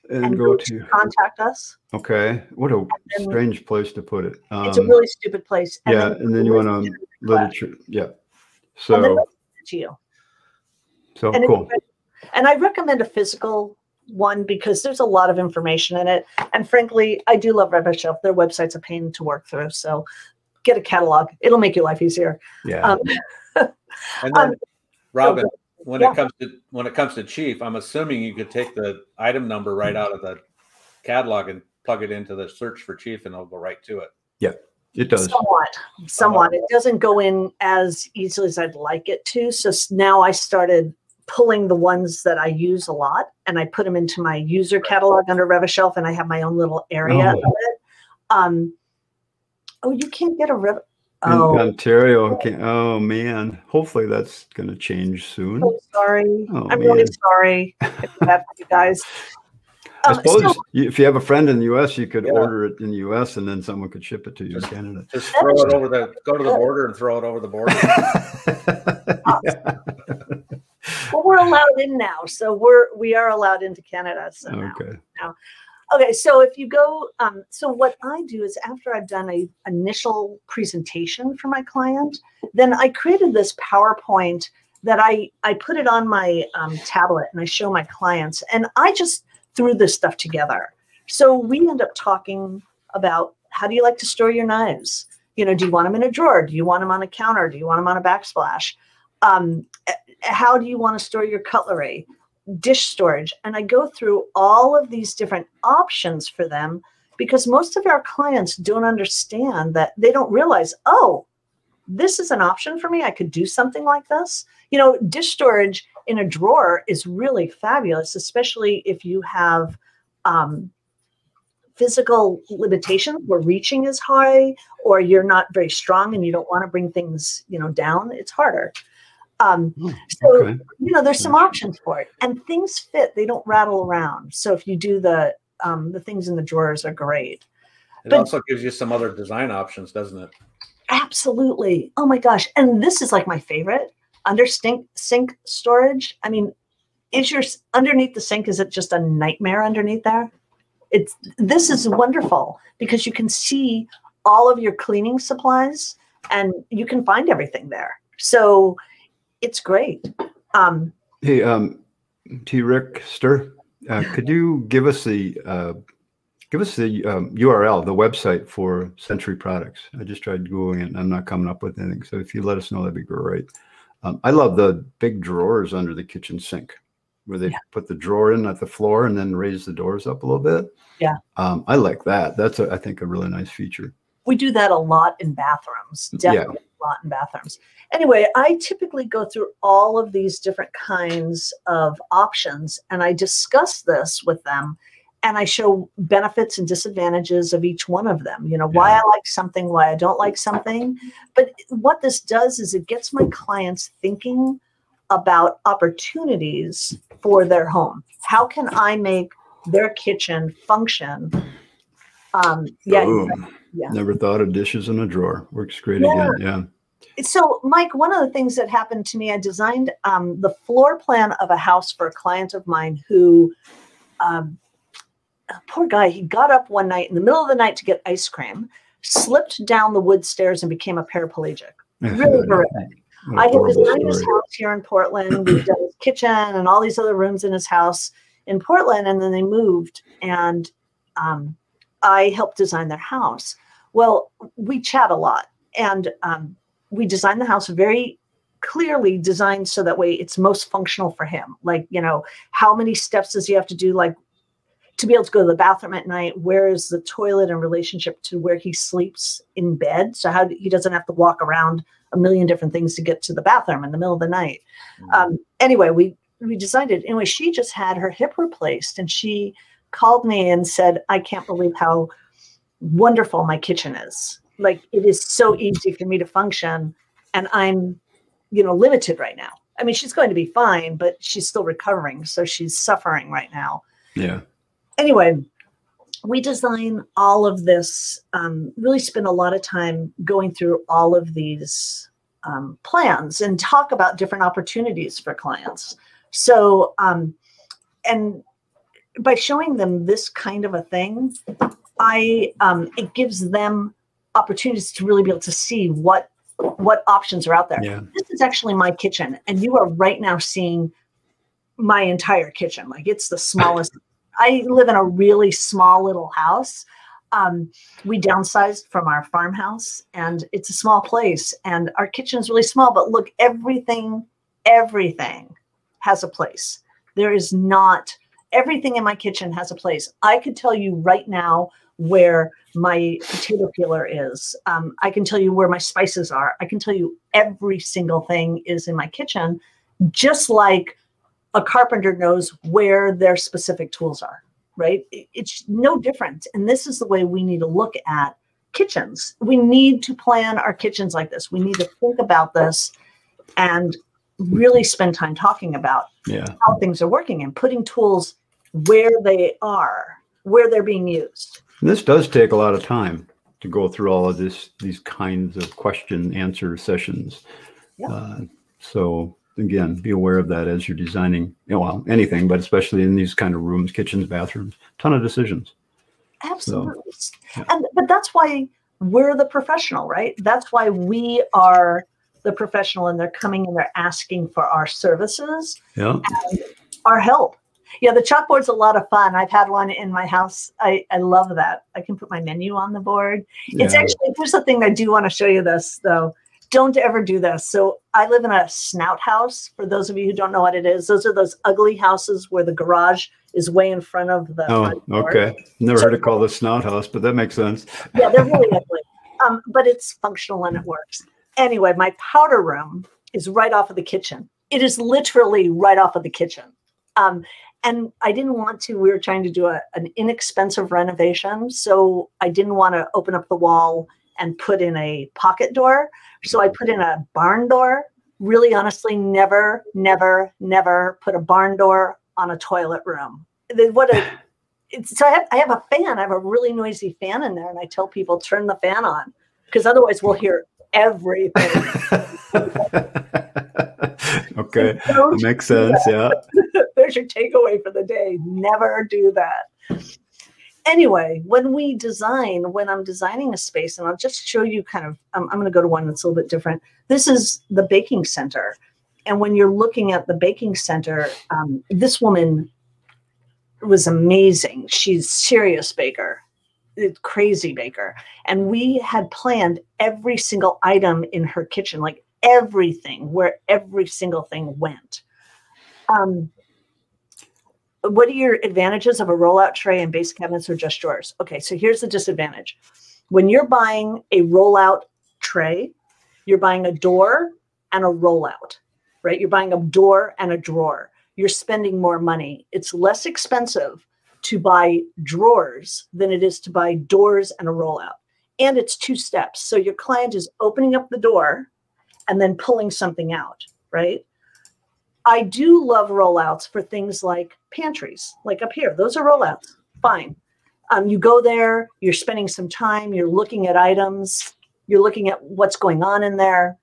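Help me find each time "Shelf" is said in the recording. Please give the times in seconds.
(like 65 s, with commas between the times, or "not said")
17 s, 45 s.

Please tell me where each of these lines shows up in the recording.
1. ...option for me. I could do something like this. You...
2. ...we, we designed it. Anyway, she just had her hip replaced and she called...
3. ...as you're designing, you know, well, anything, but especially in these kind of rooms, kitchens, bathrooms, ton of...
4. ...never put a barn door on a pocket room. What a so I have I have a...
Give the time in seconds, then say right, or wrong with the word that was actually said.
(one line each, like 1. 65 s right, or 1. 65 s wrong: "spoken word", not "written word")
1. 112 s right
2. 265 s right
3. 370 s right
4. 430 s wrong: "toilet", not "pocket".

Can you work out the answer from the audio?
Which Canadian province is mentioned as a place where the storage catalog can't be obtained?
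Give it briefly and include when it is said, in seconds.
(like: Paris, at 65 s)
Ontario, at 51 s.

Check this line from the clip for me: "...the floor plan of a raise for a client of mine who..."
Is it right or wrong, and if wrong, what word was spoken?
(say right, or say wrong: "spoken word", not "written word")
wrong: "house", not "raise".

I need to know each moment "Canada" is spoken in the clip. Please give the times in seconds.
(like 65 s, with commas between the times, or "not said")
64 s, 73 s.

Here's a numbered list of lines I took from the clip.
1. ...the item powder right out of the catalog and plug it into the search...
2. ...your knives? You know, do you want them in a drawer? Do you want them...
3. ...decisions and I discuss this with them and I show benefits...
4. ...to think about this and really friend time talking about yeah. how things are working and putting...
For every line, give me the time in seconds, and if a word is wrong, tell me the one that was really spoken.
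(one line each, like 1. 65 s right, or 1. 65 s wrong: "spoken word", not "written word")
1. 28 s wrong: "number", not "powder"
2. 94 s right
3. 192 s wrong: "options", not "decisions"
4. 351 s wrong: "spend", not "friend".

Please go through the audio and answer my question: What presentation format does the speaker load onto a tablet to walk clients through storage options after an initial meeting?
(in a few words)
PowerPoint.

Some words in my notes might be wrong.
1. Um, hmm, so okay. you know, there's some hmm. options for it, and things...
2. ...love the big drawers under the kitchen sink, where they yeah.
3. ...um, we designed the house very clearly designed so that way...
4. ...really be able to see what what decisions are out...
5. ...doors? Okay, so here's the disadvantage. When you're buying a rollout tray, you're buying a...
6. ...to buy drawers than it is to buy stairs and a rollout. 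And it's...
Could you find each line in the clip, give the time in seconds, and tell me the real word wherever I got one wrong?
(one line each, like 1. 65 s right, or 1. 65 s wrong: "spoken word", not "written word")
1. 129 s right
2. 174 s right
3. 246 s right
4. 305 s wrong: "options", not "decisions"
5. 480 s wrong: "drawers", not "doors"
6. 494 s wrong: "doors", not "stairs".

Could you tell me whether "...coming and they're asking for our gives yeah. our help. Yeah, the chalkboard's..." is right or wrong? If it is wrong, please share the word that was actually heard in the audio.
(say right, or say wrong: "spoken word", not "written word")
wrong: "services", not "gives".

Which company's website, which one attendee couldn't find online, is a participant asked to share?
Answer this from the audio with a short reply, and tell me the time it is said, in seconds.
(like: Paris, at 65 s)
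Century Products, at 168 s.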